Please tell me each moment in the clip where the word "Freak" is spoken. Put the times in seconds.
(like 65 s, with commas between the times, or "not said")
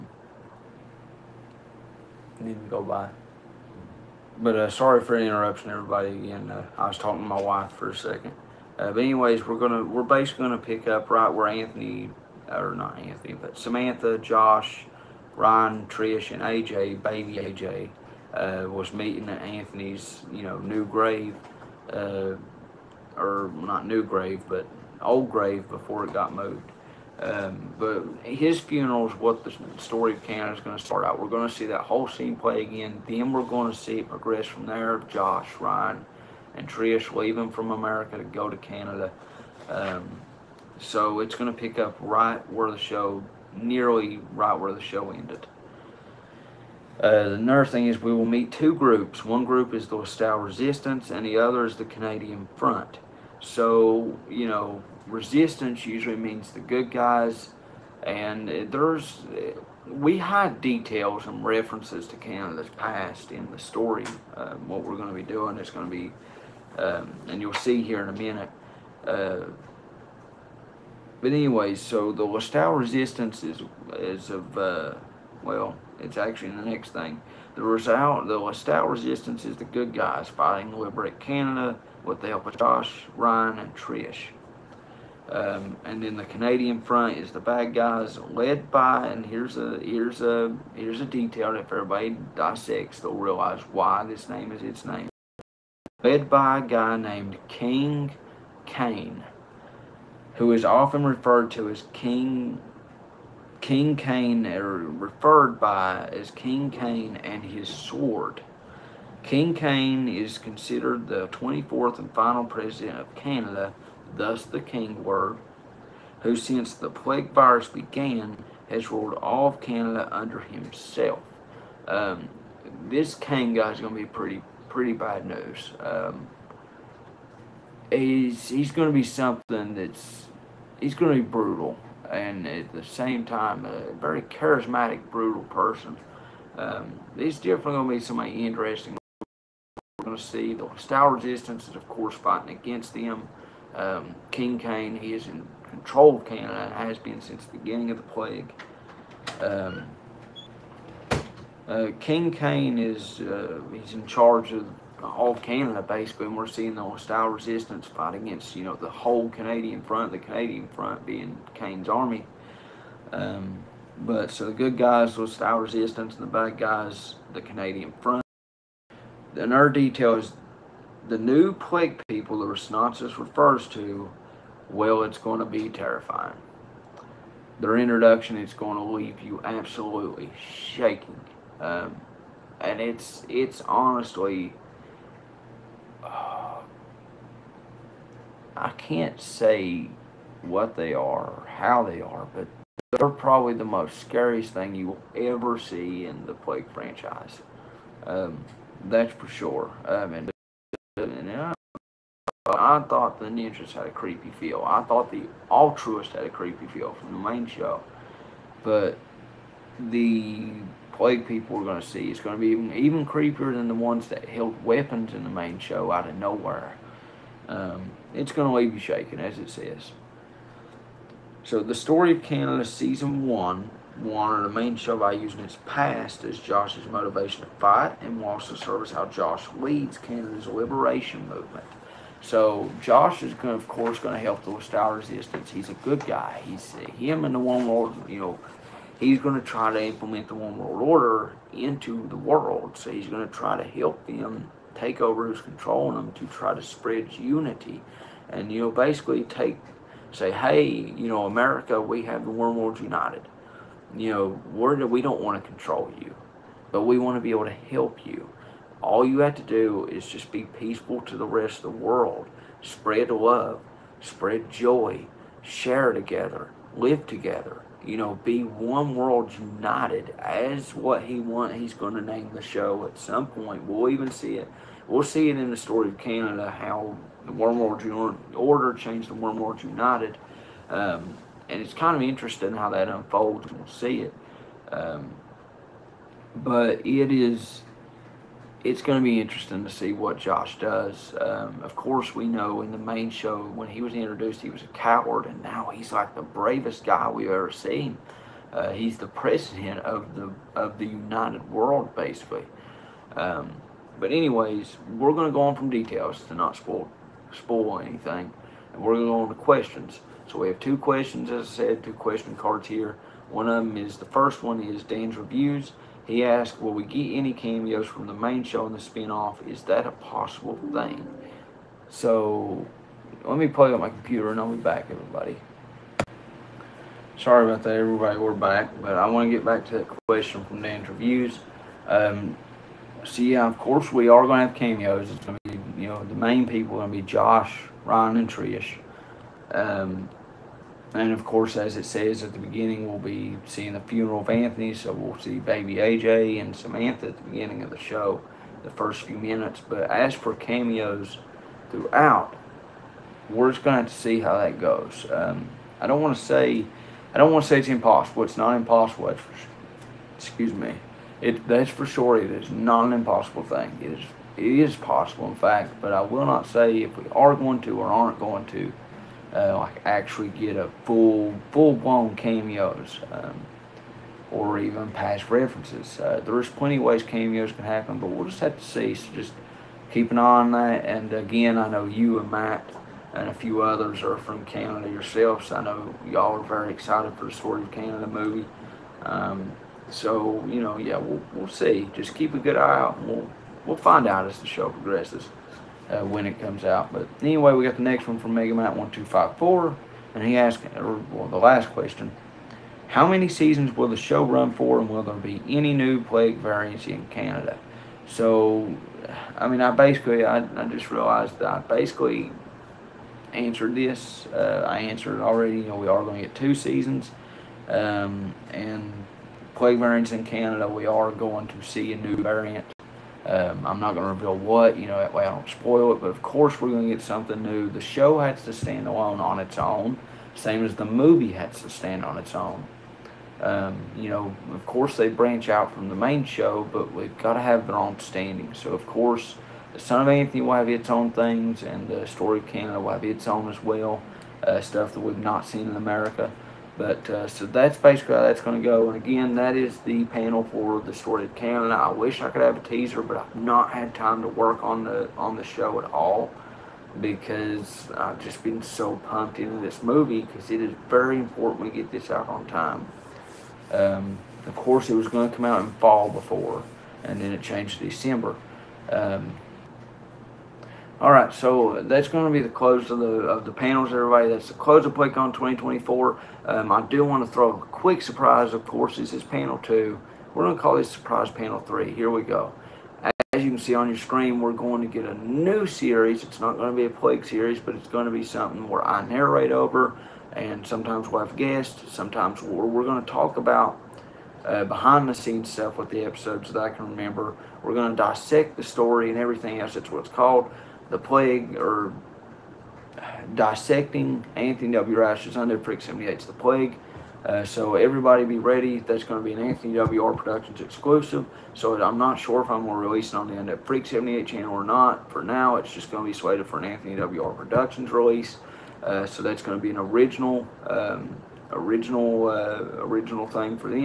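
505 s, 513 s.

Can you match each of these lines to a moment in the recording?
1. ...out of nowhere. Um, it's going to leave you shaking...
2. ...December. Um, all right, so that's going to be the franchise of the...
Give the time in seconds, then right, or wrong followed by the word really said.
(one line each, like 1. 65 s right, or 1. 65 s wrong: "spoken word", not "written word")
1. 215 s right
2. 467 s wrong: "close", not "franchise".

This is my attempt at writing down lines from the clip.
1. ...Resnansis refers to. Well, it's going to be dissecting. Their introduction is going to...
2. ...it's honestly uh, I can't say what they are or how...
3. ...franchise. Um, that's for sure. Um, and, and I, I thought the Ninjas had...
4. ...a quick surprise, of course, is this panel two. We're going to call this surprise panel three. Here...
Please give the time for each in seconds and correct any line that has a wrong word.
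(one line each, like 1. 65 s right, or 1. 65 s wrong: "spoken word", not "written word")
1. 172 s wrong: "terrifying", not "dissecting"
2. 183 s right
3. 196 s right
4. 477 s right.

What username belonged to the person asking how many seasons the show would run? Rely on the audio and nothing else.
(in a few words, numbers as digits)
Megamite1254.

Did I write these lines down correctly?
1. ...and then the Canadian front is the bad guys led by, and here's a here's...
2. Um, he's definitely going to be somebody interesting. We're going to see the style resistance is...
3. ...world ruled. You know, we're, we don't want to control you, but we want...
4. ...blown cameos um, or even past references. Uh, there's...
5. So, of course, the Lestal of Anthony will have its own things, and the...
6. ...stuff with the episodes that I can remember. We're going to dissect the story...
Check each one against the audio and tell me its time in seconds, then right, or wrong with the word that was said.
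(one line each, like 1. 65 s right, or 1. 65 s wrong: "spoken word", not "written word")
1. 85 s right
2. 136 s right
3. 252 s wrong: "united", not "ruled"
4. 371 s right
5. 438 s wrong: "Son", not "Lestal"
6. 495 s right.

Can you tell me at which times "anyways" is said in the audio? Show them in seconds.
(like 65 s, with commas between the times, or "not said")
8 s, 71 s, 304 s, 397 s.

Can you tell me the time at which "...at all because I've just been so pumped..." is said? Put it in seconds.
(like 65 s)
455 s.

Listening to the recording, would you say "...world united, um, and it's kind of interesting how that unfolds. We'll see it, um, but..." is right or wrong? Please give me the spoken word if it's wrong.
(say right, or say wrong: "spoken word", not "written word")
right.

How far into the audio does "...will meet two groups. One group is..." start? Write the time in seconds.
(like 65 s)
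48 s.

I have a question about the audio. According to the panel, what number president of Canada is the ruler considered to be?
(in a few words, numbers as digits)
24th.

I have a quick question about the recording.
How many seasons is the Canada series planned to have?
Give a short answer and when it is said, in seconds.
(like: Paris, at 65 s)
2, at 416 s.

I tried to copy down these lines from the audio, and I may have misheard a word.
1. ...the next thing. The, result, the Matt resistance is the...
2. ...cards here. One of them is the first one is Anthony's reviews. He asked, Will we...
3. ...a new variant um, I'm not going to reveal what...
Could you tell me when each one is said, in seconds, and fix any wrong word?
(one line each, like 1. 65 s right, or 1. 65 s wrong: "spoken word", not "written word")
1. 76 s wrong: "Lestal", not "Matt"
2. 312 s wrong: "Dan", not "Anthony"
3. 421 s right.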